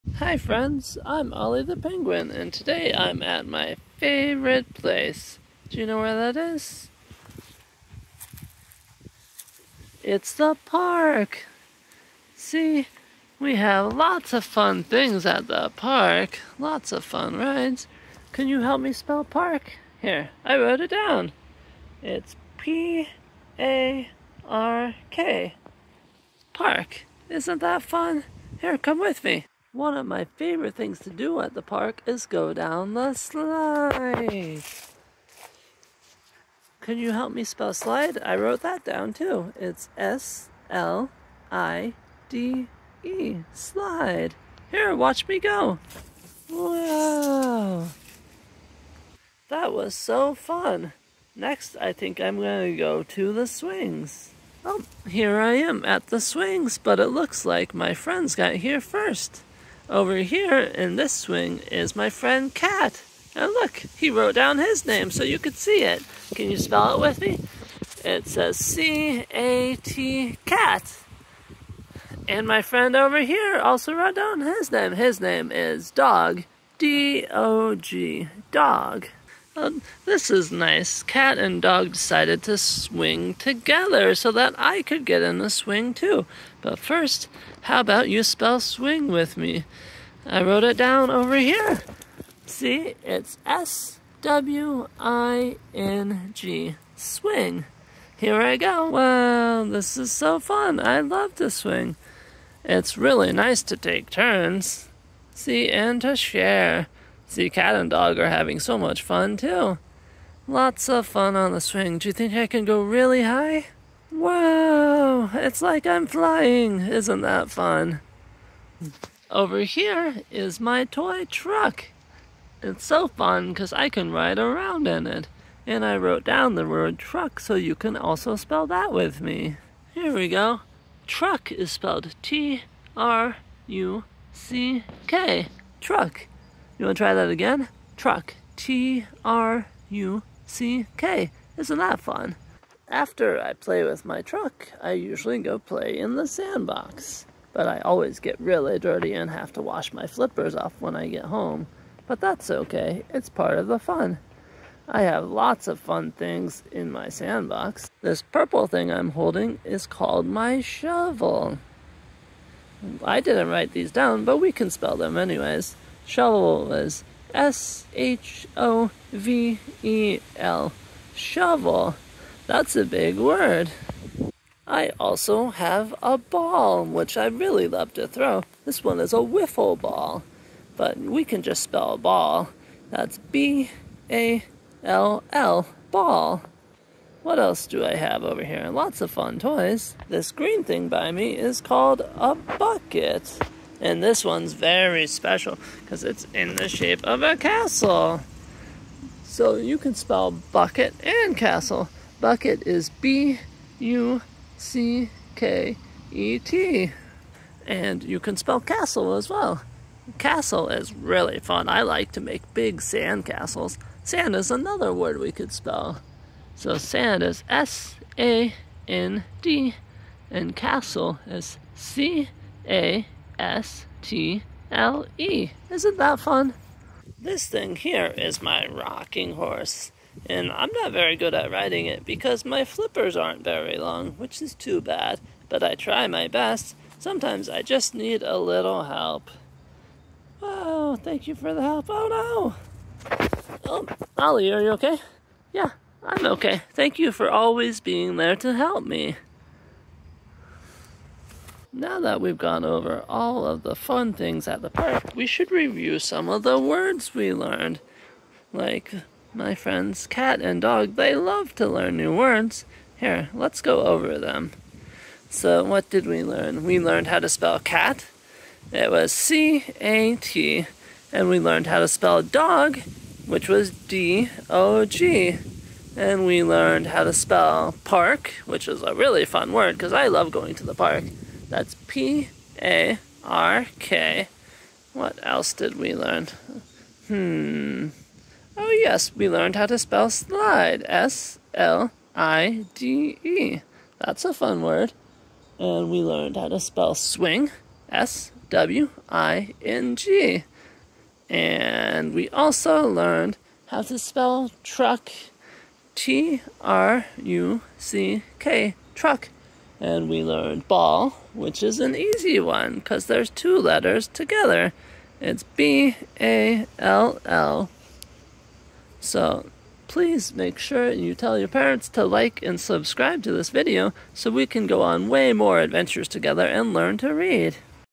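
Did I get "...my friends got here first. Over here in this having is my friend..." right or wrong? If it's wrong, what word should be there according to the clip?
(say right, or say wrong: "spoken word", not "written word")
wrong: "swing", not "having".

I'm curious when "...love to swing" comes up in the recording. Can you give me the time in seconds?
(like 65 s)
101 s.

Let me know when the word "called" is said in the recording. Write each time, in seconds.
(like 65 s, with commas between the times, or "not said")
159 s, 191 s.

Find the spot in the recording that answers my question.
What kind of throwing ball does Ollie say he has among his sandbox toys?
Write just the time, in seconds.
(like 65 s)
179 s.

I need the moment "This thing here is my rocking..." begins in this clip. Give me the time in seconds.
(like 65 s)
227 s.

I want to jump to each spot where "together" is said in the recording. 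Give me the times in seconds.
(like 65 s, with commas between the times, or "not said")
83 s, 314 s, 326 s.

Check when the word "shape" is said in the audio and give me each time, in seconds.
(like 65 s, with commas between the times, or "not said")
196 s.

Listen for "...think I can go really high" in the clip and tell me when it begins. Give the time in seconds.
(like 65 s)
112 s.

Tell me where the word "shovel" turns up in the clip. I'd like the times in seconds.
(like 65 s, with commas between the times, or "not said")
160 s, 166 s, 171 s.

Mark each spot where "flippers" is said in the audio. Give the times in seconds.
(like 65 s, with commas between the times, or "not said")
150 s, 232 s.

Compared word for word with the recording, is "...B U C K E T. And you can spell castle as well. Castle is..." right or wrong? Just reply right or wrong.
right.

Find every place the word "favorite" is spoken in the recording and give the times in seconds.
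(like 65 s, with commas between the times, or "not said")
3 s, 30 s.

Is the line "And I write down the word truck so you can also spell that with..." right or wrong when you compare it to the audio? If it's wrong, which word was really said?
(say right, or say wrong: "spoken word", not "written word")
wrong: "wrote", not "write".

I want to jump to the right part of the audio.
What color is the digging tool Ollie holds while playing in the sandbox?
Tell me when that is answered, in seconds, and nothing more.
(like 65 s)
158 s.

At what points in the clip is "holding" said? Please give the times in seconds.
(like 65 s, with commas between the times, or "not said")
159 s.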